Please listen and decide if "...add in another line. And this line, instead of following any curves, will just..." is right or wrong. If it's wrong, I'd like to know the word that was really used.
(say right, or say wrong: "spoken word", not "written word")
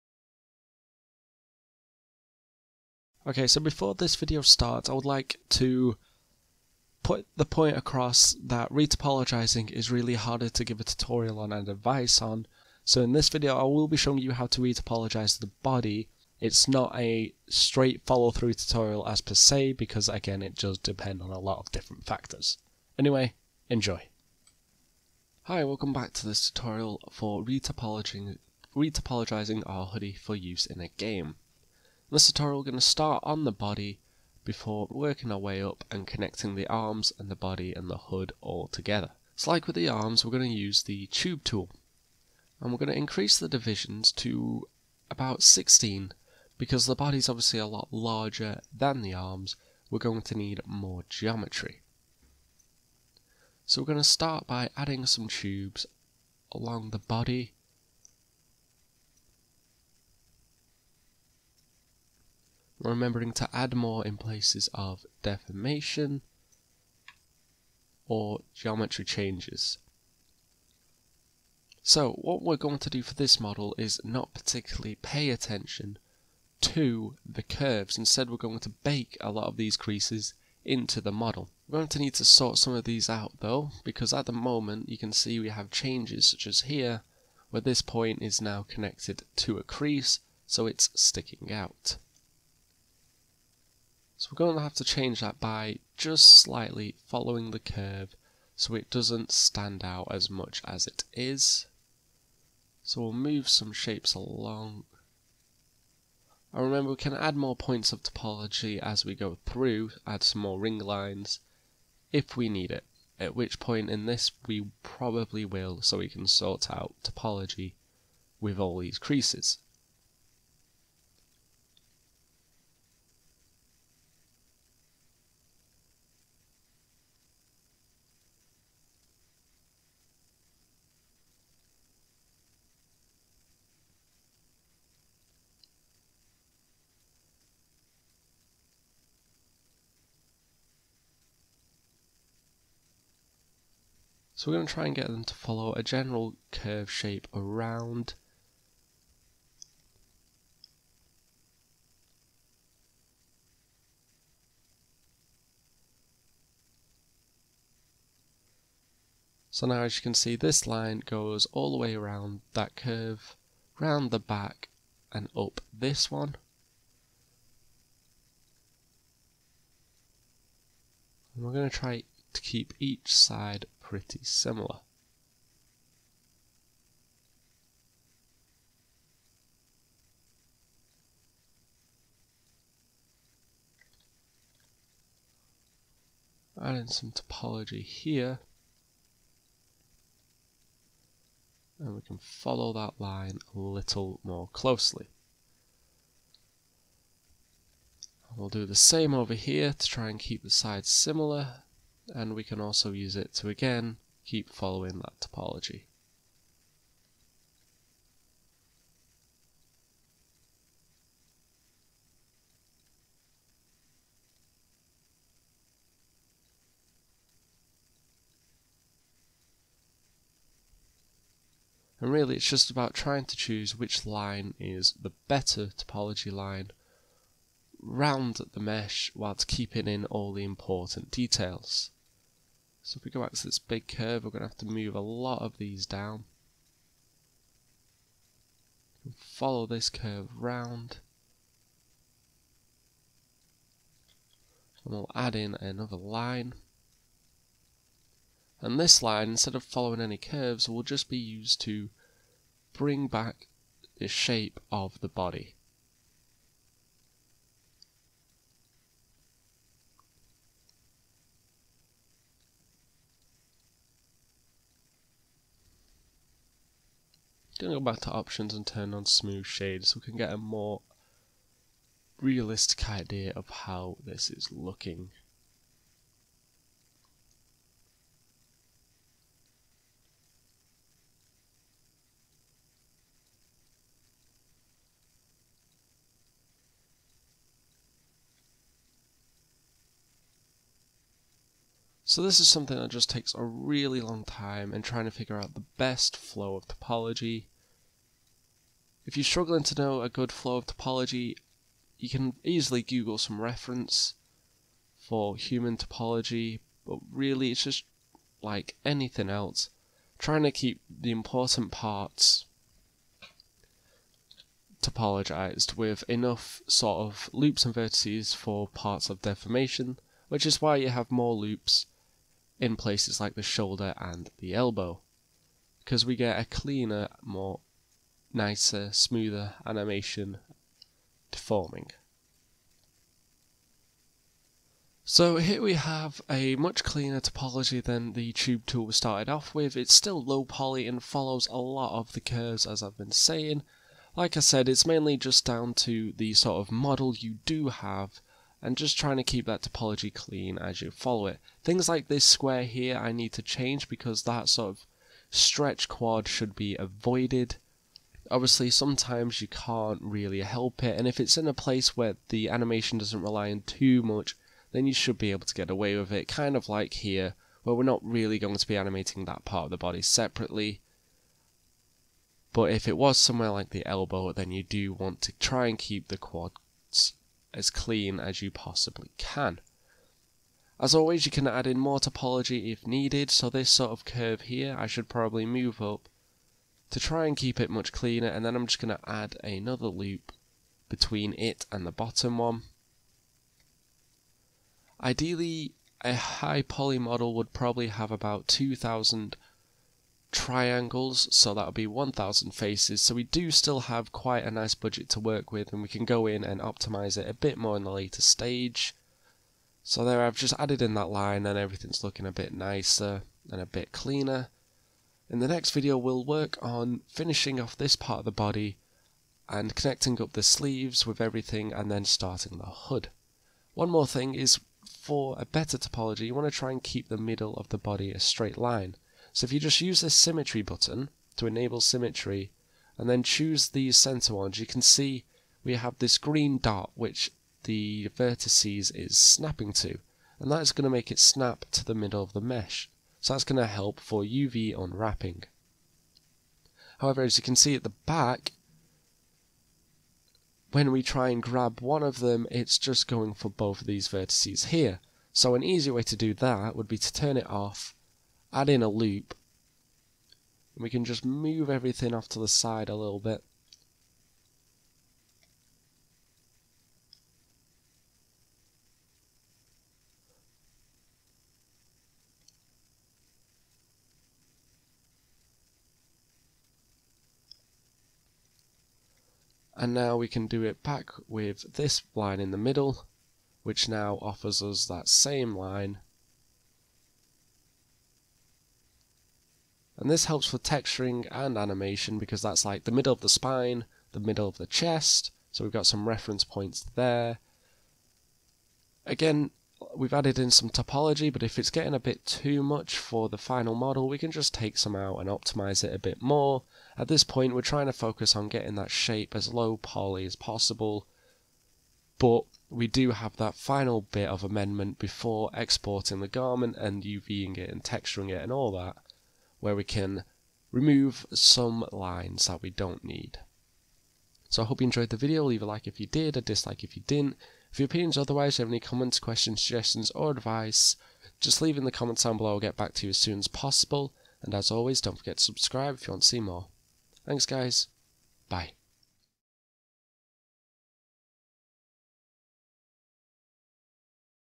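right.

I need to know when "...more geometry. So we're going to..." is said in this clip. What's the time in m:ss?
0:50.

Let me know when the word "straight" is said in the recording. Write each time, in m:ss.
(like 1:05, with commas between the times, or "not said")
0:17, 7:08.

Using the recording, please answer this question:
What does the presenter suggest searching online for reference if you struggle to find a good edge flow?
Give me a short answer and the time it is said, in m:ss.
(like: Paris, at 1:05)
human topology, at 5:05.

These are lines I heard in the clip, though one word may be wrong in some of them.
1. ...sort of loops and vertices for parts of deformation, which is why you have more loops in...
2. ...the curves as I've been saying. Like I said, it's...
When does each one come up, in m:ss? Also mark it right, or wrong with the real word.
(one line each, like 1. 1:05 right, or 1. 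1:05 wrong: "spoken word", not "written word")
1. 5:16 right
2. 5:42 right.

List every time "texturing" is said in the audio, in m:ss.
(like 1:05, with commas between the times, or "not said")
8:10, 8:37.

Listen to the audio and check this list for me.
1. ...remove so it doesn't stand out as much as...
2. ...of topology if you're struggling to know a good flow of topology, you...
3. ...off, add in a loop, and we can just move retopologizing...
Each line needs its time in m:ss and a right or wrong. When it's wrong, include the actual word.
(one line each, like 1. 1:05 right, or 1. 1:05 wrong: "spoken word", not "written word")
1. 1:37 wrong: "curve", not "remove"
2. 4:56 right
3. 7:37 wrong: "everything", not "retopologizing".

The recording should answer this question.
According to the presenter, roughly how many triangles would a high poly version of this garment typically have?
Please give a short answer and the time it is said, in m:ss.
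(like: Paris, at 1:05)
2000, at 6:38.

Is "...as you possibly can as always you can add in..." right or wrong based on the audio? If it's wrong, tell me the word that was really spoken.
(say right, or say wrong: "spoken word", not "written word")
right.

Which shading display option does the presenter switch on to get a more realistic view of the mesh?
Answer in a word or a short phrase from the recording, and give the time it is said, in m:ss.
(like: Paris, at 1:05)
smooth shade, at 4:29.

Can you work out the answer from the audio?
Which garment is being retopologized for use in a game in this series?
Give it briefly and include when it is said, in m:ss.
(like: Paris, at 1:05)
hoodie, at 0:29.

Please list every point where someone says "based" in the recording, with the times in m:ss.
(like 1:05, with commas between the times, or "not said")
not said.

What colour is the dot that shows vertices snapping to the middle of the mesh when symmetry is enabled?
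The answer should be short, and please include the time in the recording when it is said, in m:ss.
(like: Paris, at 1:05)
green, at 7:16.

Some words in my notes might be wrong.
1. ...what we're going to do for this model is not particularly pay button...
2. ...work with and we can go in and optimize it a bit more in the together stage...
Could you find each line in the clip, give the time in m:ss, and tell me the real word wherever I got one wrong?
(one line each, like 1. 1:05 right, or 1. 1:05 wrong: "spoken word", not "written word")
1. 1:12 wrong: "attention", not "button"
2. 6:45 wrong: "later", not "together".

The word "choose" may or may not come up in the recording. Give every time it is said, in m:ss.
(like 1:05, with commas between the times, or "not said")
3:43, 7:13.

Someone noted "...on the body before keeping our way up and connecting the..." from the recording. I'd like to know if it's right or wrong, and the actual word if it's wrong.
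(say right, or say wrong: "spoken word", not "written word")
wrong: "working", not "keeping".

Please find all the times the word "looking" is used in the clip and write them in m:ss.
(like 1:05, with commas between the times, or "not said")
4:34, 6:52.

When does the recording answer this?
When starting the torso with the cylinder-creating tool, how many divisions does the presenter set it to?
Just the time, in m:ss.
0:45.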